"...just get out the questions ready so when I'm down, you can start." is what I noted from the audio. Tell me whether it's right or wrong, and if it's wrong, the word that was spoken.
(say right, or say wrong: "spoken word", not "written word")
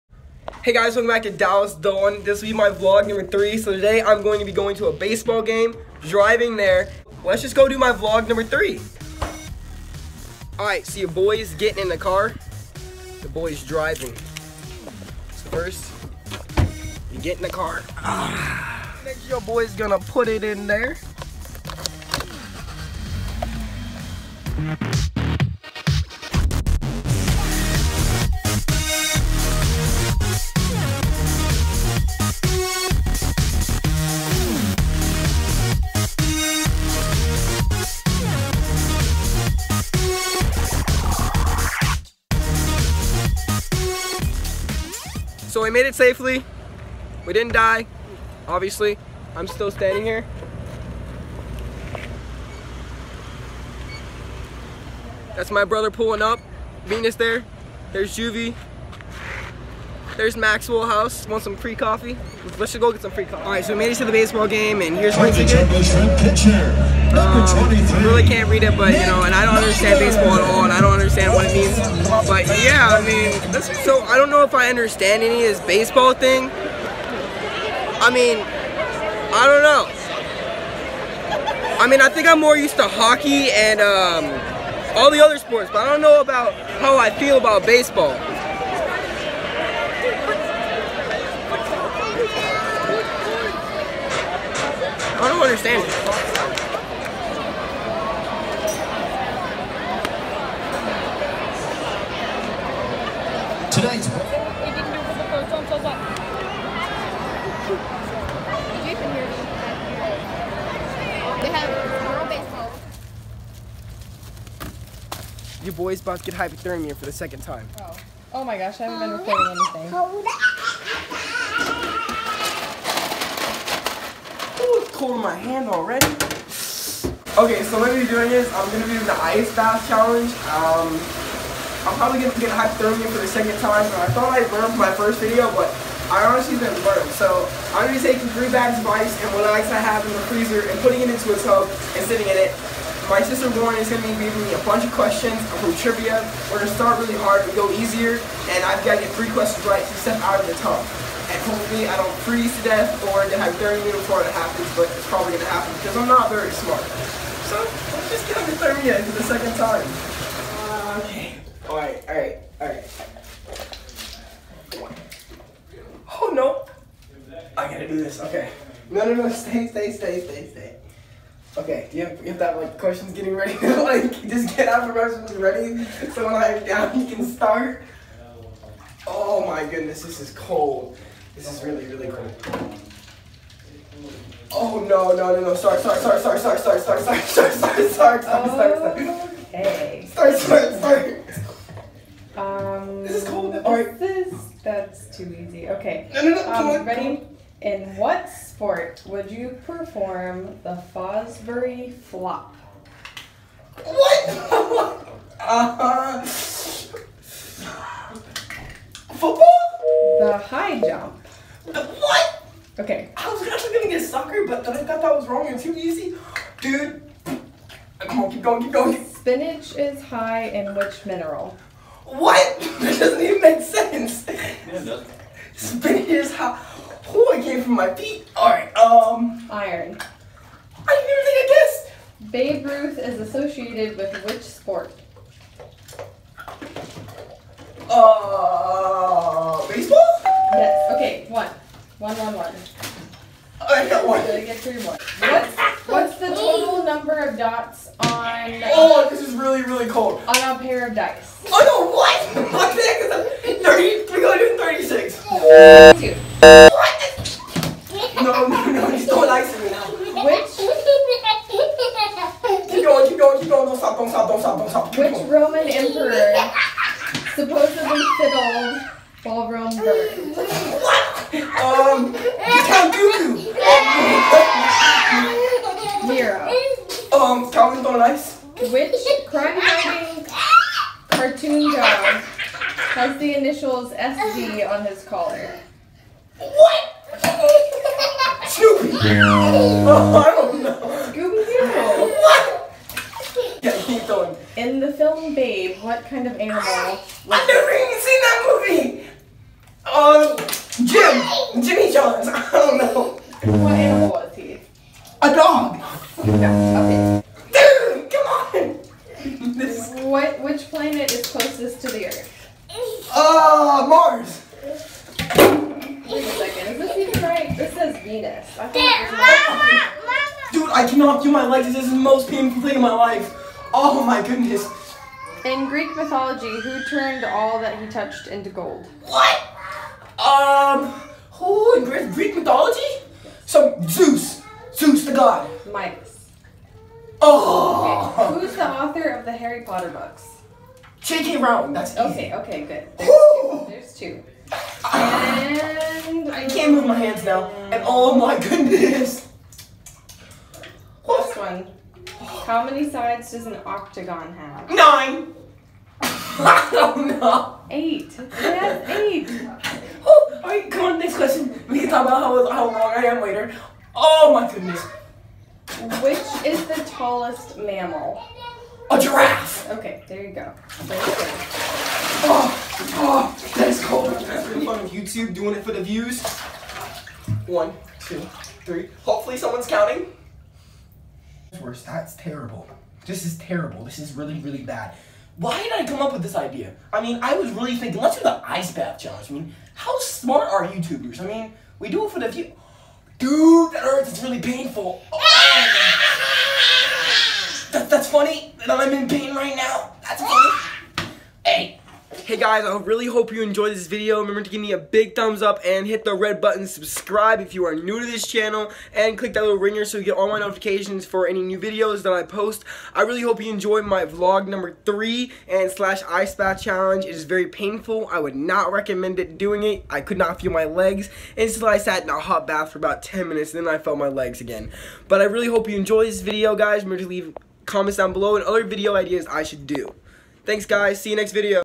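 right.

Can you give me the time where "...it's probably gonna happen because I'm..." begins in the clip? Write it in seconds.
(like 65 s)
154 s.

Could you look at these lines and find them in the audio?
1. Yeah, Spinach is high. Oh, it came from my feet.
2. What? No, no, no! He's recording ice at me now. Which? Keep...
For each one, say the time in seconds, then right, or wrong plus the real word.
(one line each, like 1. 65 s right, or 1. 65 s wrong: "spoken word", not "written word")
1. 224 s right
2. 256 s wrong: "throwing", not "recording".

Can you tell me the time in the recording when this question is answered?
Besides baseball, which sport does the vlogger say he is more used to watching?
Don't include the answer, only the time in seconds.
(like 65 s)
82 s.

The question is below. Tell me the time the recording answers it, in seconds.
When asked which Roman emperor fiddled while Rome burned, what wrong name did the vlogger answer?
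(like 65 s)
272 s.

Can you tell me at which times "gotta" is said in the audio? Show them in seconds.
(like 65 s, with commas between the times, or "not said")
167 s, 244 s.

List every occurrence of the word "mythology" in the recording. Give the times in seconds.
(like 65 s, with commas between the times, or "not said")
325 s, 332 s.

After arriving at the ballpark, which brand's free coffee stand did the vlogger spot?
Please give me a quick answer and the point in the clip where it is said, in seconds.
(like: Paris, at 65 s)
Maxwell House, at 60 s.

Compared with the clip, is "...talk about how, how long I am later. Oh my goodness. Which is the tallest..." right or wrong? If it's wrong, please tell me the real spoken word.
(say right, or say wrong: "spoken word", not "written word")
right.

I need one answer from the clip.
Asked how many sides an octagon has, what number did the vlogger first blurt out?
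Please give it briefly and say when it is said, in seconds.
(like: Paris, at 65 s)
9, at 354 s.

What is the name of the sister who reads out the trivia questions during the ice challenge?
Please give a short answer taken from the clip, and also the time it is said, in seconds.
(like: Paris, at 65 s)
Lauren, at 143 s.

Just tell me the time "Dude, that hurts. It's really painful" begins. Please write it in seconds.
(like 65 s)
393 s.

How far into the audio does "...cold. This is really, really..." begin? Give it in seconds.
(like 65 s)
180 s.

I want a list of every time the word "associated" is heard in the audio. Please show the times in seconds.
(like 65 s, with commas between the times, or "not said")
233 s.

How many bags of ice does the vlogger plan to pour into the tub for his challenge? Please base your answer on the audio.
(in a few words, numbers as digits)
3.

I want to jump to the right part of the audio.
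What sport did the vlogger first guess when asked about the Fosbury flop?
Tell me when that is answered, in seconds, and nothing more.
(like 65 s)
209 s.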